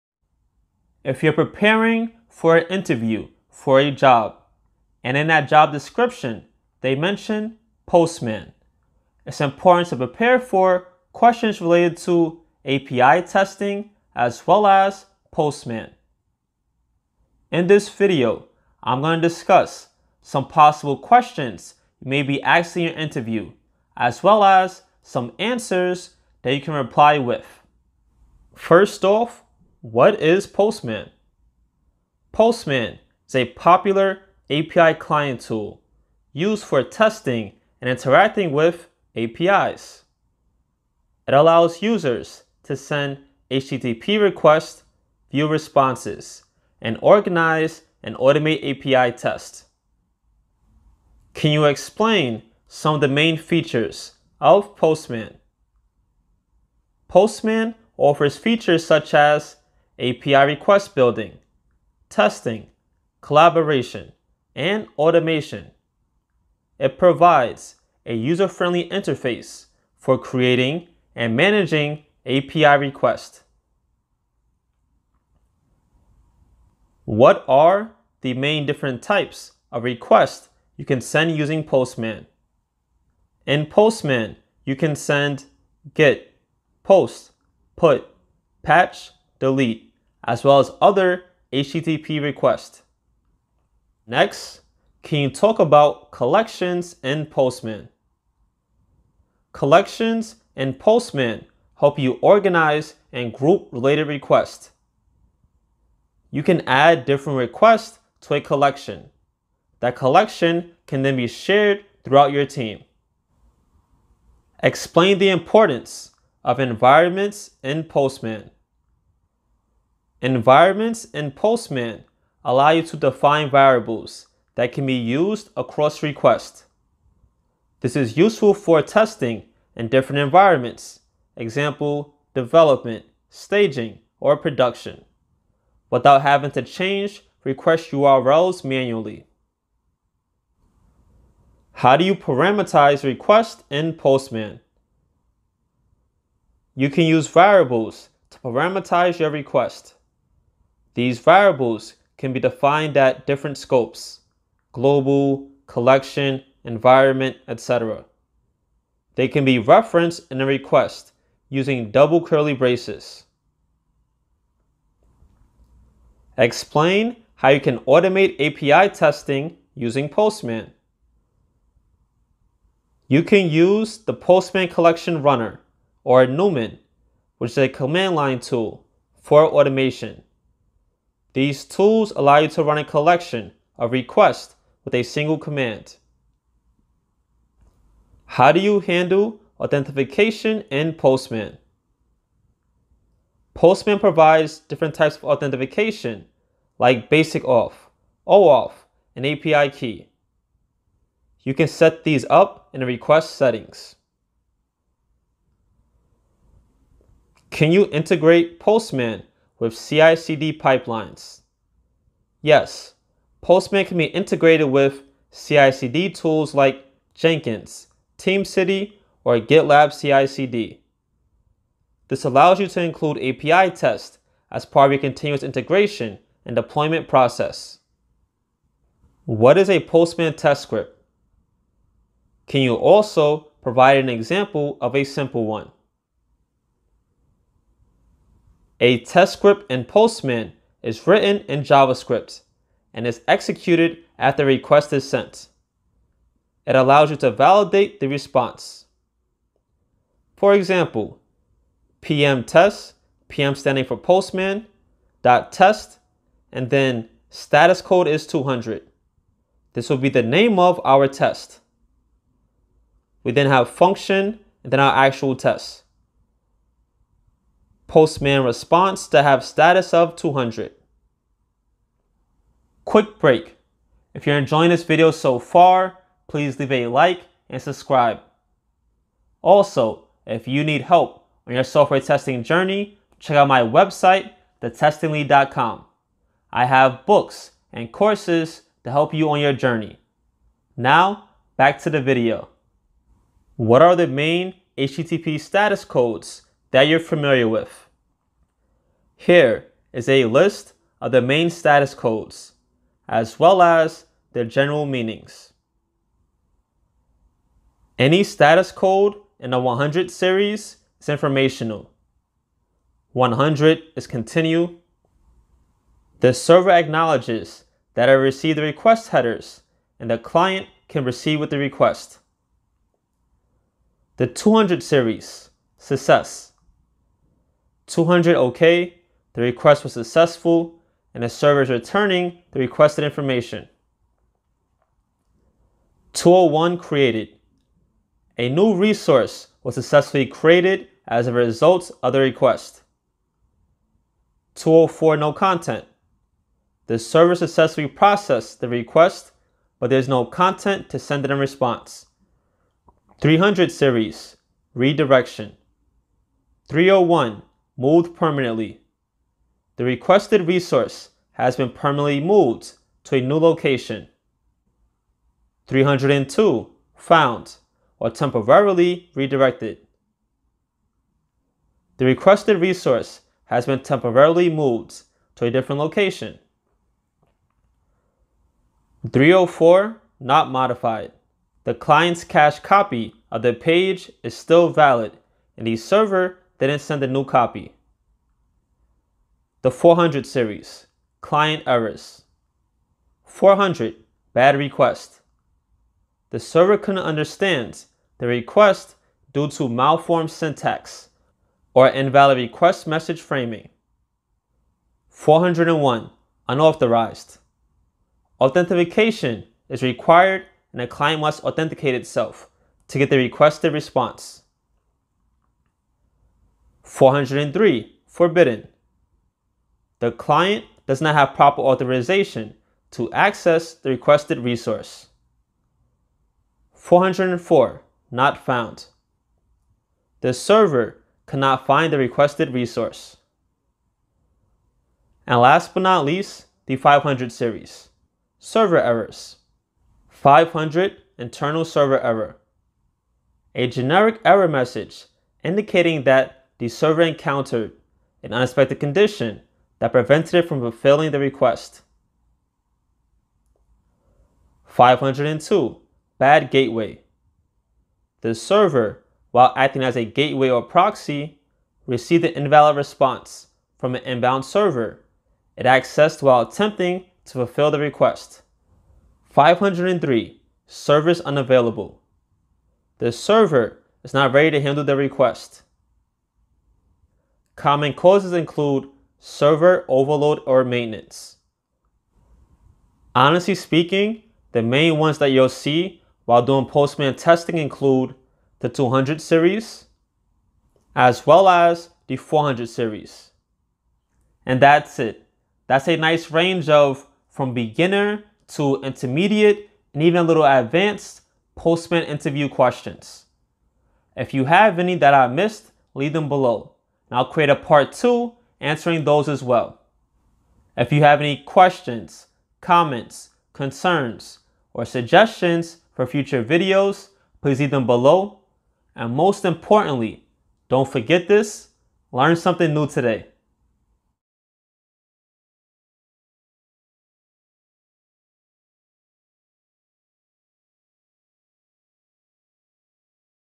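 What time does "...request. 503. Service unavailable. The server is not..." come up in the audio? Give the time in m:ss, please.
7:47.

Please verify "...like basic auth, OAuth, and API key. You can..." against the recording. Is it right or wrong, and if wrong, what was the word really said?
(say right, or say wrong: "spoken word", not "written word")
right.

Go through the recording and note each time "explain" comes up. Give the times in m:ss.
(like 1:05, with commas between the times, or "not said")
0:51, 1:54, 2:46.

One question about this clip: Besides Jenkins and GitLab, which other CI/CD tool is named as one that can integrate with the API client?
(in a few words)
TeamCity.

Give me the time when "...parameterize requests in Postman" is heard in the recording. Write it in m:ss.
2:22.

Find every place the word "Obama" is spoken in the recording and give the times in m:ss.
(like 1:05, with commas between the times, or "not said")
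not said.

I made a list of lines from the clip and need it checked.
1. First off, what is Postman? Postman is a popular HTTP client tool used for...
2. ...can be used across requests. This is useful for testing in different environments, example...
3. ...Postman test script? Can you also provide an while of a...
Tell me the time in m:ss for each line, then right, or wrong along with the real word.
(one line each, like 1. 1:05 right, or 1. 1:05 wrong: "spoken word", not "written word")
1. 0:28 wrong: "API", not "HTTP"
2. 2:04 right
3. 3:49 wrong: "example", not "while".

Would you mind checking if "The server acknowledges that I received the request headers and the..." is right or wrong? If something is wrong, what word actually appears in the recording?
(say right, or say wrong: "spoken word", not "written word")
right.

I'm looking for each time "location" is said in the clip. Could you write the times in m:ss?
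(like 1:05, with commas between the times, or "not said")
6:03, 6:15.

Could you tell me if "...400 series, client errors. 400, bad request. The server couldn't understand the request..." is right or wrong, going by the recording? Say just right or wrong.
right.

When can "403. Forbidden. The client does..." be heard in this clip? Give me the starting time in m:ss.
6:57.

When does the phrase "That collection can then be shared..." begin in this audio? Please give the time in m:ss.
1:49.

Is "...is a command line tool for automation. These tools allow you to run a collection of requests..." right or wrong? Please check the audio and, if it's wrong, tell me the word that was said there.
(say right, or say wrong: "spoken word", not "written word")
right.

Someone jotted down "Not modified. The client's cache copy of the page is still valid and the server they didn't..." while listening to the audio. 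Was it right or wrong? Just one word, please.
right.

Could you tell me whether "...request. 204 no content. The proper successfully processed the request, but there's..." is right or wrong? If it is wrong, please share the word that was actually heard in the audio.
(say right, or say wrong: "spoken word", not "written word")
wrong: "server", not "proper".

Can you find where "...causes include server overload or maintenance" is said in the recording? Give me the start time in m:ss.
7:57.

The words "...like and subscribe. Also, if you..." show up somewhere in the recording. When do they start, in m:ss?
4:36.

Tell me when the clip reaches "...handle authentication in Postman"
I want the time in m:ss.
3:08.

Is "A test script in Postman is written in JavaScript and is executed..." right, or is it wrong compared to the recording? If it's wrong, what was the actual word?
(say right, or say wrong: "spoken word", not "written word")
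right.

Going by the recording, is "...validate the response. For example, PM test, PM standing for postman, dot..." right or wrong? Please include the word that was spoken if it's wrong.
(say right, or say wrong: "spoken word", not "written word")
right.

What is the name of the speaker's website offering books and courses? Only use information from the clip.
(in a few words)
thetestinglead.com.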